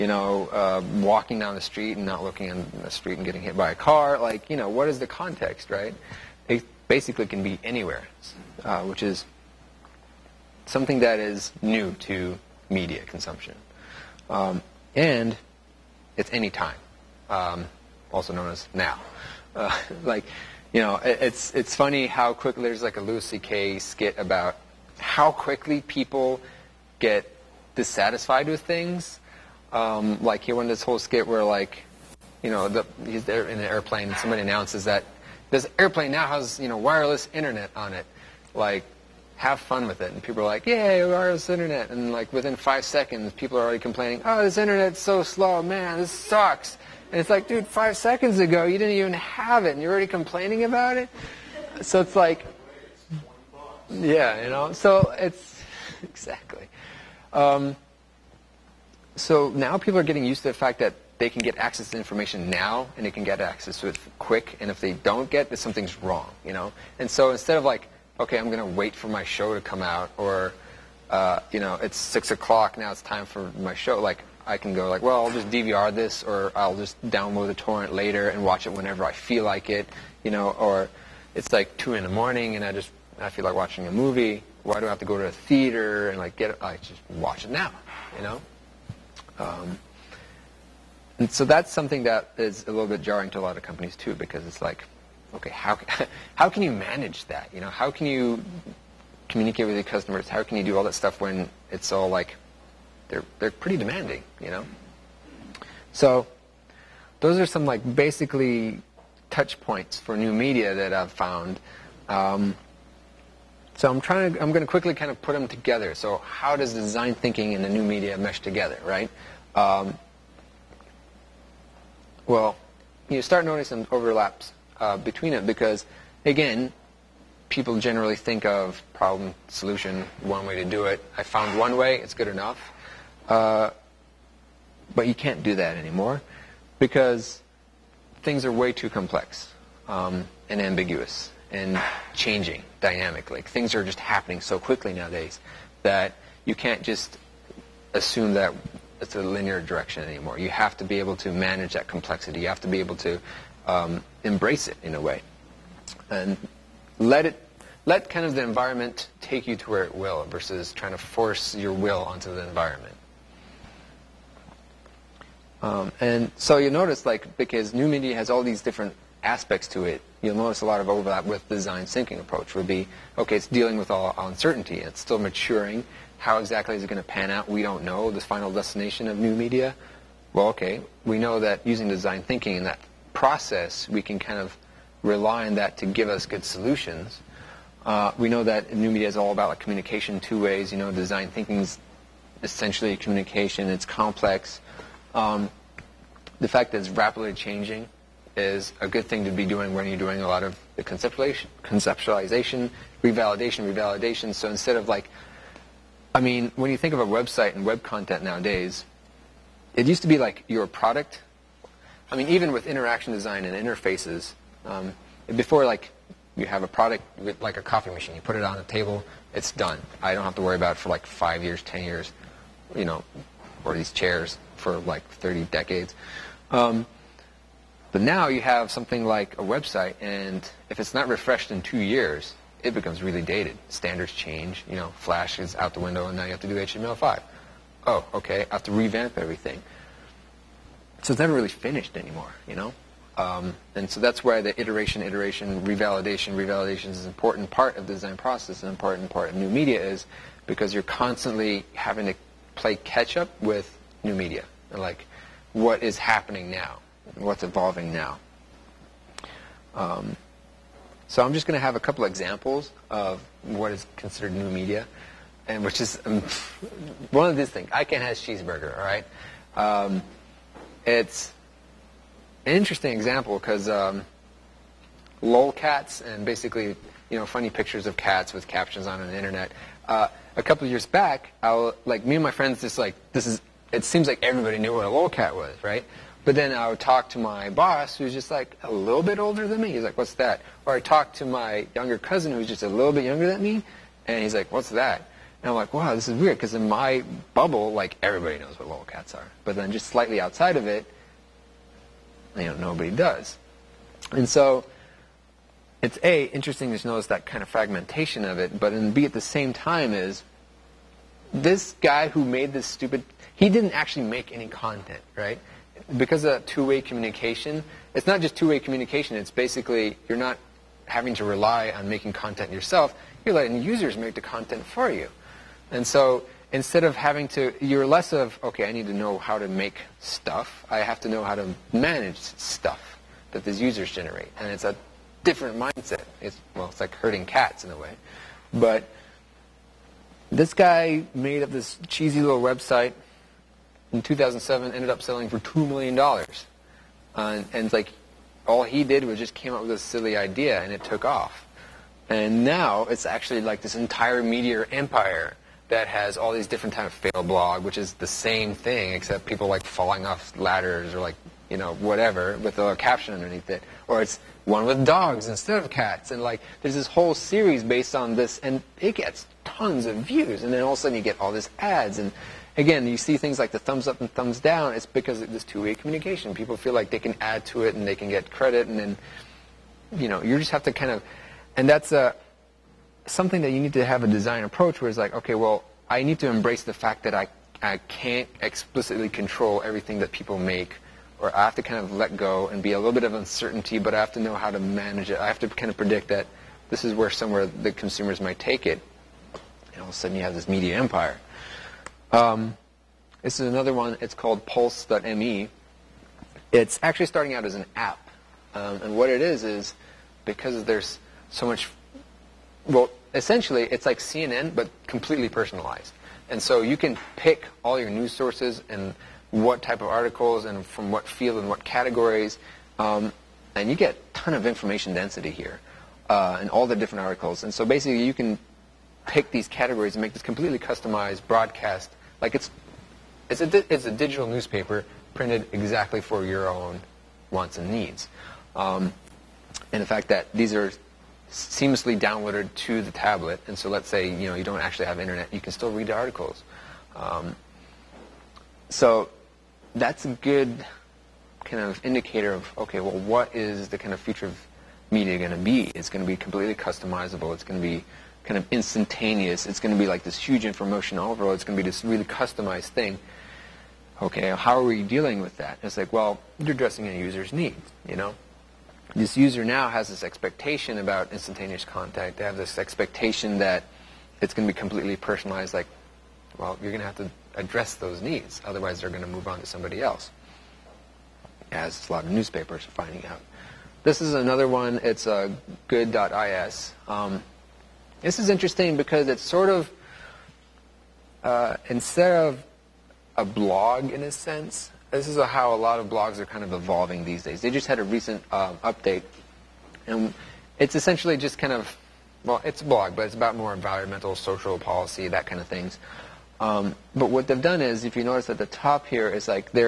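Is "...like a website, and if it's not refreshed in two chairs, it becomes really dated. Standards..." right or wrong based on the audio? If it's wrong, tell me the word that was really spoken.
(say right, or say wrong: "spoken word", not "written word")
wrong: "years", not "chairs".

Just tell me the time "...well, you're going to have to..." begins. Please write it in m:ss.
7:56.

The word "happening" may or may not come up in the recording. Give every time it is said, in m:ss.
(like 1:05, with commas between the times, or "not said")
2:23, 4:15.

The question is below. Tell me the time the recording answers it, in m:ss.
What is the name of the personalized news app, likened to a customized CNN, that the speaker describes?
6:44.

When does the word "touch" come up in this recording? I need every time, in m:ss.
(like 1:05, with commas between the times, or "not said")
1:49.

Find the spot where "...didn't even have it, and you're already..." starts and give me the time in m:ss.
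0:48.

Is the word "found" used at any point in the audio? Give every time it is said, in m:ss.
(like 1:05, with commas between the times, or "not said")
1:51, 2:11.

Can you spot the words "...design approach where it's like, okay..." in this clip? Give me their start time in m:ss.
6:24.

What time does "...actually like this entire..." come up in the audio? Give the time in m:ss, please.
5:53.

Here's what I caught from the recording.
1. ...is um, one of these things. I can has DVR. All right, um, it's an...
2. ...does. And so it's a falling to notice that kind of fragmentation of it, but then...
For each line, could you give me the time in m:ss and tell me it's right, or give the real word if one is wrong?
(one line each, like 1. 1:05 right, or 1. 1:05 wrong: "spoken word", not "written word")
1. 4:25 wrong: "Cheezburger", not "DVR"
2. 5:02 wrong: "interesting", not "falling".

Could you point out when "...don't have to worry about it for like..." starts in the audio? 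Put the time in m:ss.
3:40.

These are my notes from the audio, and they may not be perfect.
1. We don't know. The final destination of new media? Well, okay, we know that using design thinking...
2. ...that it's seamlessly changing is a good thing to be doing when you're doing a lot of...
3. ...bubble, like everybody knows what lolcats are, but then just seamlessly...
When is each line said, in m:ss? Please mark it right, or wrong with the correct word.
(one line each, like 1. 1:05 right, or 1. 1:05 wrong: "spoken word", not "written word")
1. 2:57 right
2. 3:16 wrong: "rapidly", not "seamlessly"
3. 4:57 wrong: "slightly", not "seamlessly".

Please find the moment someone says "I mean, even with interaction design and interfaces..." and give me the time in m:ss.
3:32.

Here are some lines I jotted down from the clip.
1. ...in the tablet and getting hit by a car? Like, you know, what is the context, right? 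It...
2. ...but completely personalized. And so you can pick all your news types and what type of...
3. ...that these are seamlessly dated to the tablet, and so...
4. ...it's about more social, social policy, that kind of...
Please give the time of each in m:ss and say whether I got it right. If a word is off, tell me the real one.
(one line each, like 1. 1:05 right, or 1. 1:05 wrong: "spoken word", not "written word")
1. 0:02 wrong: "street", not "tablet"
2. 6:54 wrong: "sources", not "types"
3. 7:20 wrong: "downloaded", not "dated"
4. 8:23 wrong: "environmental", not "social".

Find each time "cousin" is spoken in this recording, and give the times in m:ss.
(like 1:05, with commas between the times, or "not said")
4:51.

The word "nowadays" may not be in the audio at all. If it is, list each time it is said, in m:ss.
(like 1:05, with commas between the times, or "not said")
2:24, 3:28.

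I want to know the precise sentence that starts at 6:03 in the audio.
Or it's one with dogs instead of cats.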